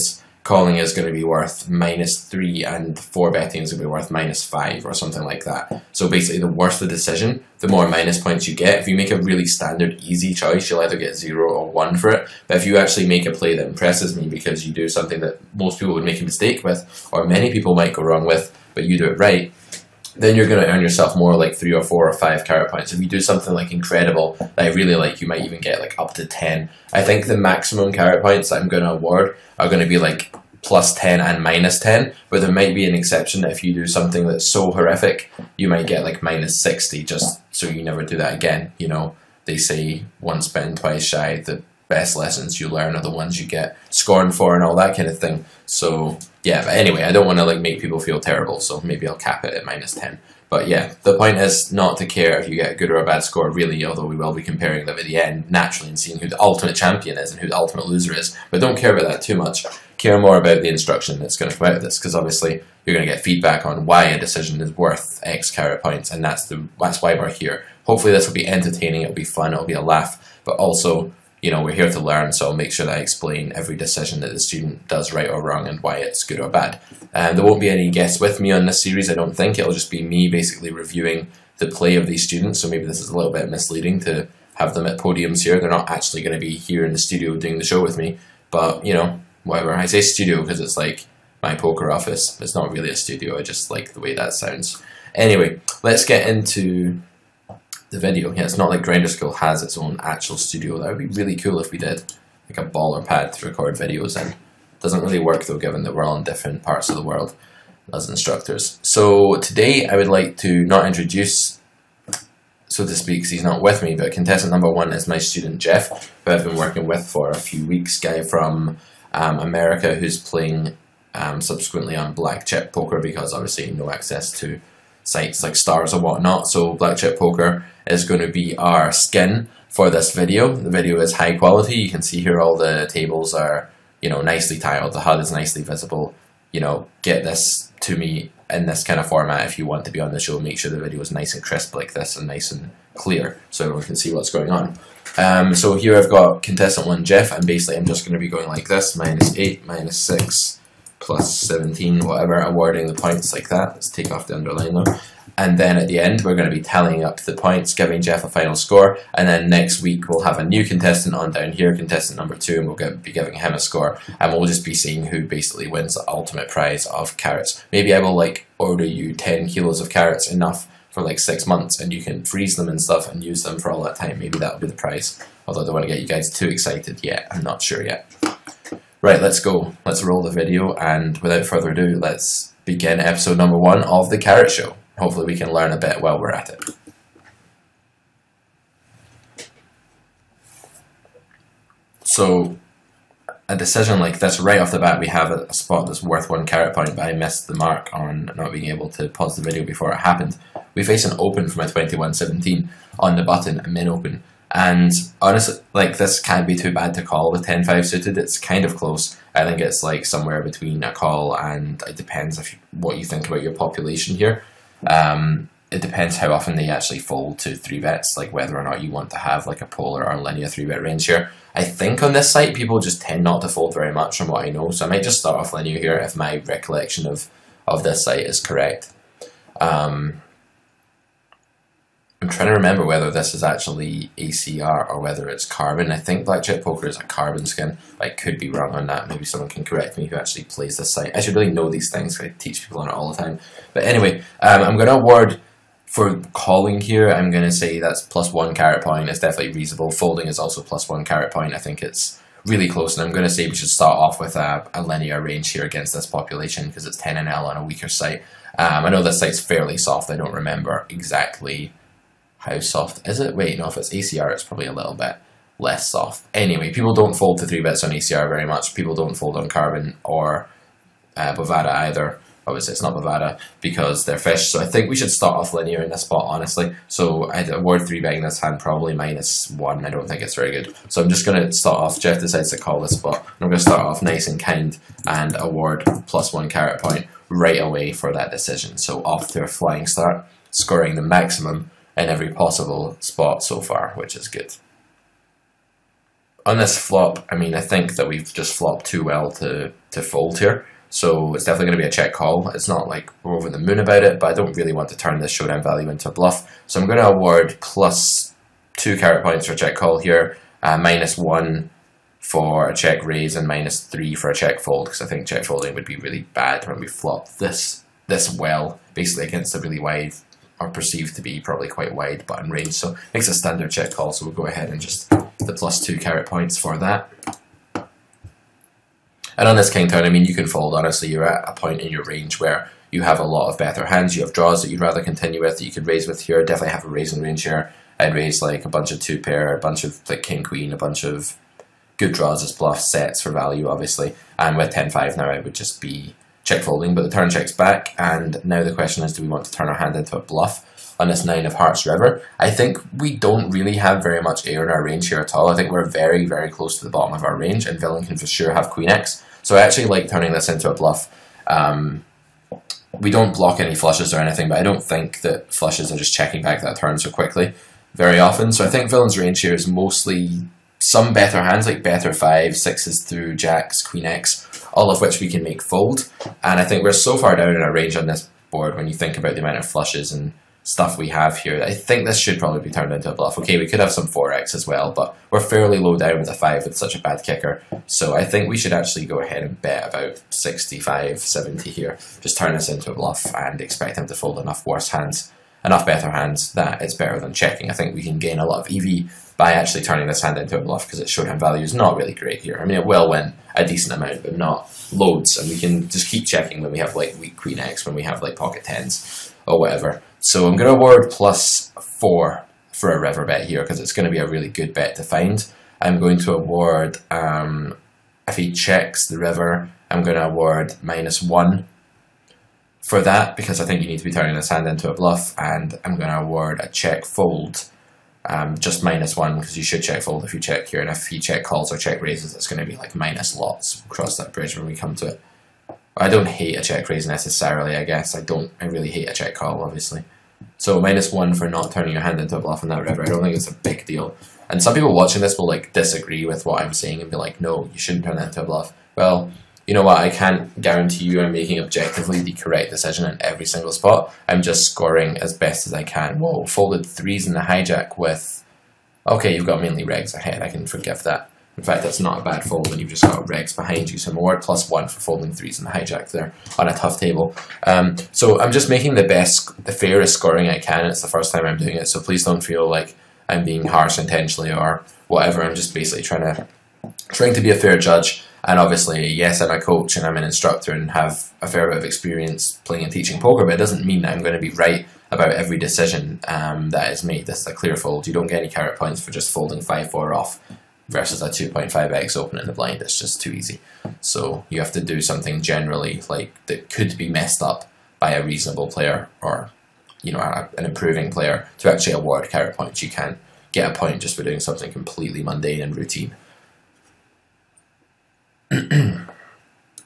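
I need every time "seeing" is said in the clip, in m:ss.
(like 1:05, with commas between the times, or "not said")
0:55, 2:44.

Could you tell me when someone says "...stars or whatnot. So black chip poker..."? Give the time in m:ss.
2:05.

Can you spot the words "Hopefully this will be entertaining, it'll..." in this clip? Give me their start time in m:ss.
1:07.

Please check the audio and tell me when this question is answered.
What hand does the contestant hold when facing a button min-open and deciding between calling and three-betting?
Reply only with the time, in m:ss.
3:27.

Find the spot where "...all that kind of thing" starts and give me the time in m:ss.
0:44.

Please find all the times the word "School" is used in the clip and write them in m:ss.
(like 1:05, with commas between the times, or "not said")
1:39.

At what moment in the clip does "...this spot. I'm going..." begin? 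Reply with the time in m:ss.
4:42.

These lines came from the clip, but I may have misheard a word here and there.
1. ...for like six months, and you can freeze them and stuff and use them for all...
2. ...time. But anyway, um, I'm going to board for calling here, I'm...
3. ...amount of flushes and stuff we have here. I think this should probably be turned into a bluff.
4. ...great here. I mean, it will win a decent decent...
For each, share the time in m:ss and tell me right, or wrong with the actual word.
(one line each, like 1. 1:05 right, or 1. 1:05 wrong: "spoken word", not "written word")
1. 2:50 right
2. 4:03 wrong: "award", not "board"
3. 6:19 right
4. 6:42 wrong: "amount", not "decent".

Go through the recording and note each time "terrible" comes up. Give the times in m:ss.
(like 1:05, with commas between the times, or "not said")
0:48.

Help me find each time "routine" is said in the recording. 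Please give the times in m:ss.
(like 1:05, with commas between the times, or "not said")
8:25.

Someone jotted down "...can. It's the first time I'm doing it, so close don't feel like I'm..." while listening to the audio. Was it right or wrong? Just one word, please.
wrong.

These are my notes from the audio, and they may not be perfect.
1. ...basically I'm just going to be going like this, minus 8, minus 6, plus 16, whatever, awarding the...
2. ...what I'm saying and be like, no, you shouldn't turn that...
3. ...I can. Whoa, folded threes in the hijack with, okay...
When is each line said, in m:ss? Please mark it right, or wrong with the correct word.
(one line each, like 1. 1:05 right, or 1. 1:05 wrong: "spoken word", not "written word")
1. 2:27 wrong: "17", not "16"
2. 7:26 right
3. 7:35 right.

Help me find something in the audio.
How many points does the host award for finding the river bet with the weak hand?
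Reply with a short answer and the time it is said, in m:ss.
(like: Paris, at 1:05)
4, at 6:51.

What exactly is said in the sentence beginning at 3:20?
We face an open from a 2117 on the button, min open.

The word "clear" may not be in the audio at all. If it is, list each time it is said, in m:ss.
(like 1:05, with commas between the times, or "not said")
2:22, 8:07.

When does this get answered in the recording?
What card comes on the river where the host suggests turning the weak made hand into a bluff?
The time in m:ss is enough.
5:51.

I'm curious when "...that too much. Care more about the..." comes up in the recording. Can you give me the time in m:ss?
0:59.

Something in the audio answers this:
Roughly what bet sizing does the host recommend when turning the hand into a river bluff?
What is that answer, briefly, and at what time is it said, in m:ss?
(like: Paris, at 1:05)
65-70, at 6:30.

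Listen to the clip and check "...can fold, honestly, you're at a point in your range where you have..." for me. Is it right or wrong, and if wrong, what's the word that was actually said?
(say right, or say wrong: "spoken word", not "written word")
right.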